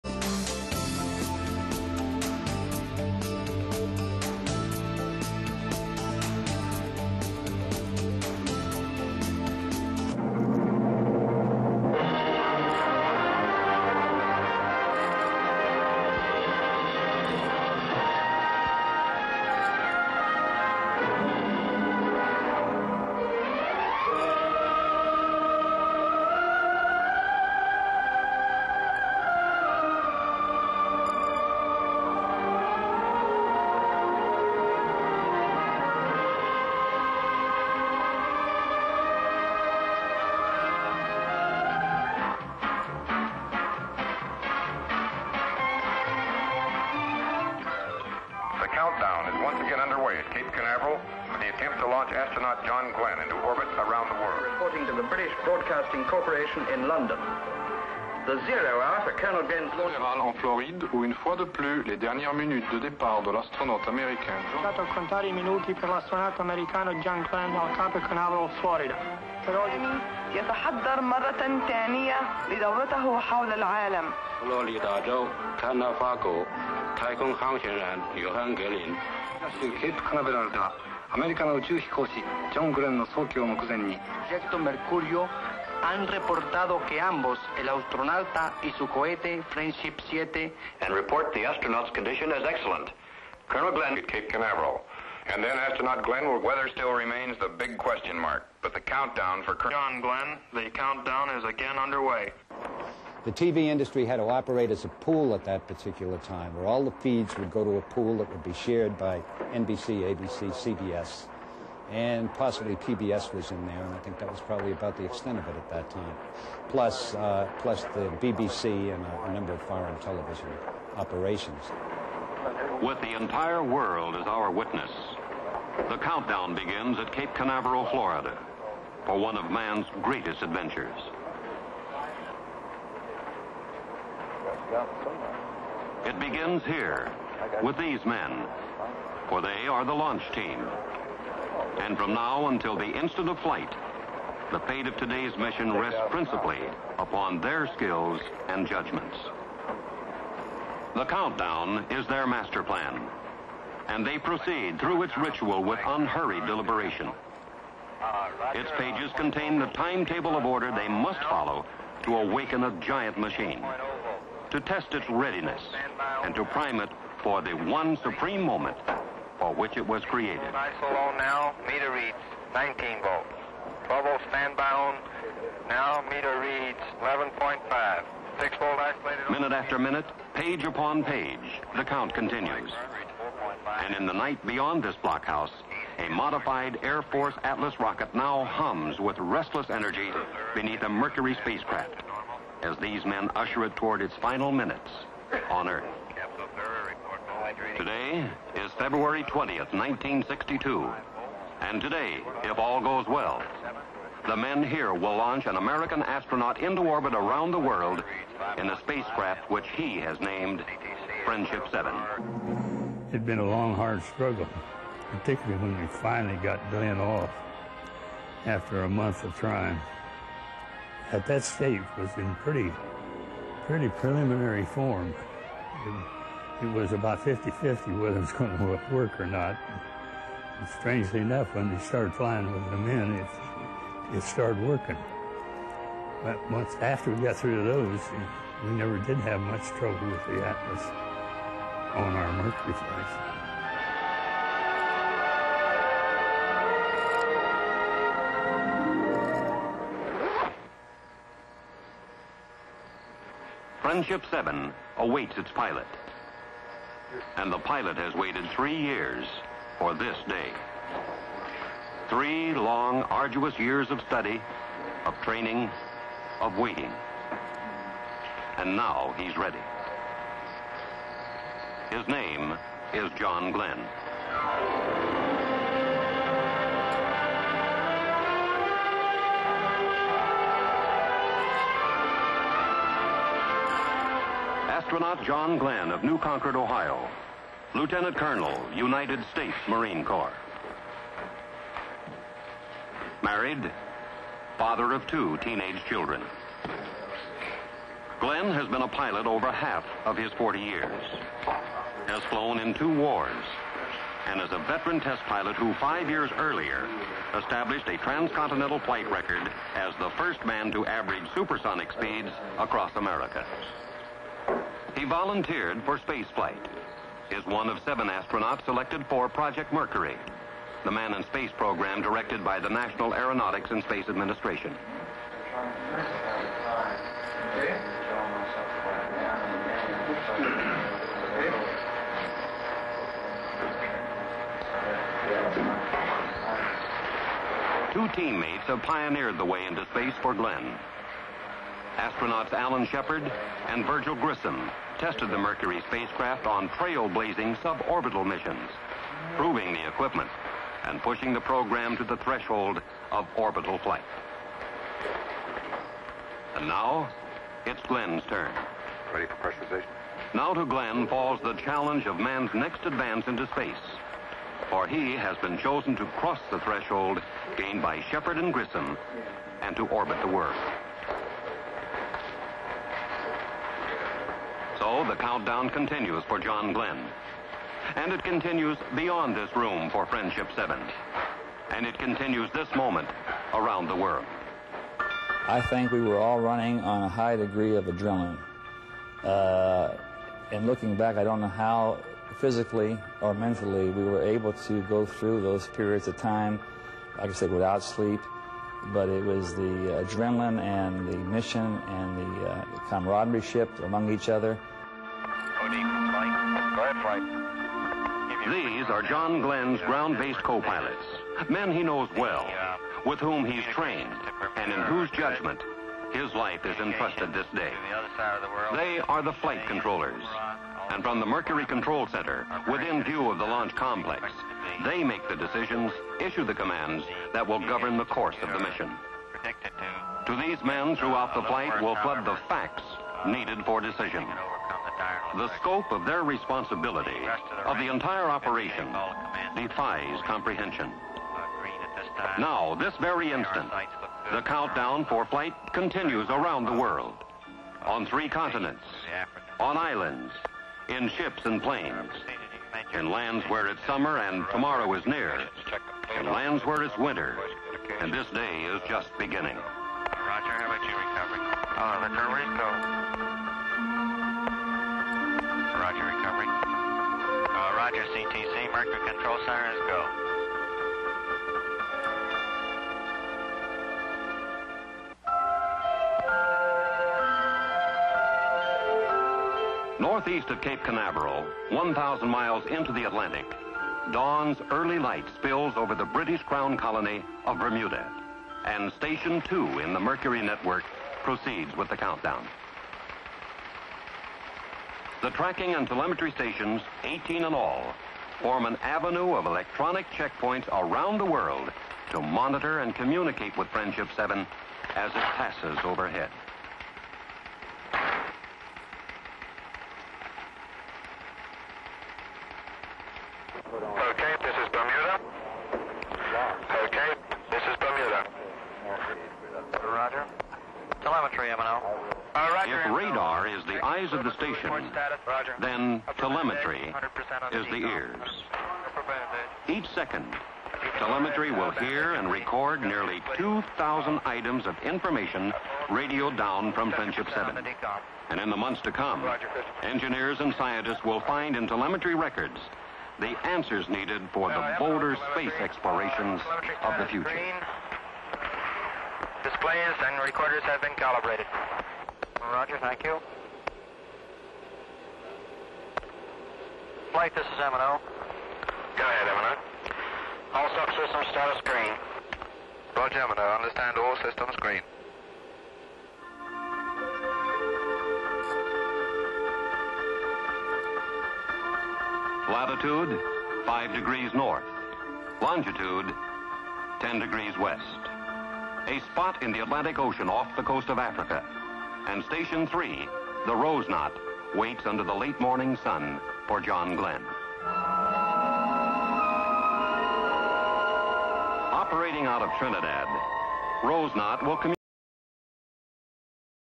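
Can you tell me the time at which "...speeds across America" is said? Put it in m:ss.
5:11.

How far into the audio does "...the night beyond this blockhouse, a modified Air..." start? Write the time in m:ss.
3:04.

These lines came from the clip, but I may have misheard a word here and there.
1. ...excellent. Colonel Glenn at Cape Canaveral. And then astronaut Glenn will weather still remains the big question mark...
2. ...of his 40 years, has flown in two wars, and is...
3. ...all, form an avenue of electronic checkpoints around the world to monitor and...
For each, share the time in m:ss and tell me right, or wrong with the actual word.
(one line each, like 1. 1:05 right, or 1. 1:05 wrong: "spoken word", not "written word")
1. 1:32 right
2. 5:00 right
3. 8:17 right.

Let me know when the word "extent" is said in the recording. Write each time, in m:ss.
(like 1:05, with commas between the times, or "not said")
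1:55.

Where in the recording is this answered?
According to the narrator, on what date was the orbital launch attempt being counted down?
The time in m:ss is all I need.
3:18.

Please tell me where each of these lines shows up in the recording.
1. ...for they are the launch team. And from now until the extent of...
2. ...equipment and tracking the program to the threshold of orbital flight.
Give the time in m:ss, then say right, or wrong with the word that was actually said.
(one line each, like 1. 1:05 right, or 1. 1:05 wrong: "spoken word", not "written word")
1. 2:19 wrong: "instant", not "extent"
2. 5:49 wrong: "pushing", not "tracking".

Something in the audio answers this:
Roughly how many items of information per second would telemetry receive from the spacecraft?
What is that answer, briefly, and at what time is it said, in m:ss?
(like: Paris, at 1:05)
2,000, at 8:53.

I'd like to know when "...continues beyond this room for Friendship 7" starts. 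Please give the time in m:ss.
6:18.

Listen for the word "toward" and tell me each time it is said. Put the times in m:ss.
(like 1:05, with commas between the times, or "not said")
3:13.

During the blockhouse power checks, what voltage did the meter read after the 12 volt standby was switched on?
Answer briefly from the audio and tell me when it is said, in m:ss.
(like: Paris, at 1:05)
11.5, at 2:57.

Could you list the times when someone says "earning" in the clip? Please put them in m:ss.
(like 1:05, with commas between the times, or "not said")
not said.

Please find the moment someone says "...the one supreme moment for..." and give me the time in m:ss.
2:47.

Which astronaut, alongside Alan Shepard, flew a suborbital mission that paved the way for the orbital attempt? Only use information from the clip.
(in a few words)
Virgil Grissom.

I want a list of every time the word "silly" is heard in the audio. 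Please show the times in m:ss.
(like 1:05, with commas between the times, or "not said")
not said.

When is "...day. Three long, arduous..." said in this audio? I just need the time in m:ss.
4:20.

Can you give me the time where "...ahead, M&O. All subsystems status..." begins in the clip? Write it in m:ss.
9:17.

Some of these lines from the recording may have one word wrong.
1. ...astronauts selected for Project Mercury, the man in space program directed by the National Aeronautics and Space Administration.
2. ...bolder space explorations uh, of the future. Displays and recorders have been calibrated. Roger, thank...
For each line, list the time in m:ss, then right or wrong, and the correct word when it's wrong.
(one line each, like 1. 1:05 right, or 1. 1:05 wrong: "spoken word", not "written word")
1. 5:18 right
2. 9:04 right.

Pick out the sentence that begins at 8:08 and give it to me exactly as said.
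And Station 2 in the Mercury network proceeds with the countdown.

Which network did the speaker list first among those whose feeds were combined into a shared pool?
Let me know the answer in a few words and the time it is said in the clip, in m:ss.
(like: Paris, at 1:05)
NBC, at 1:49.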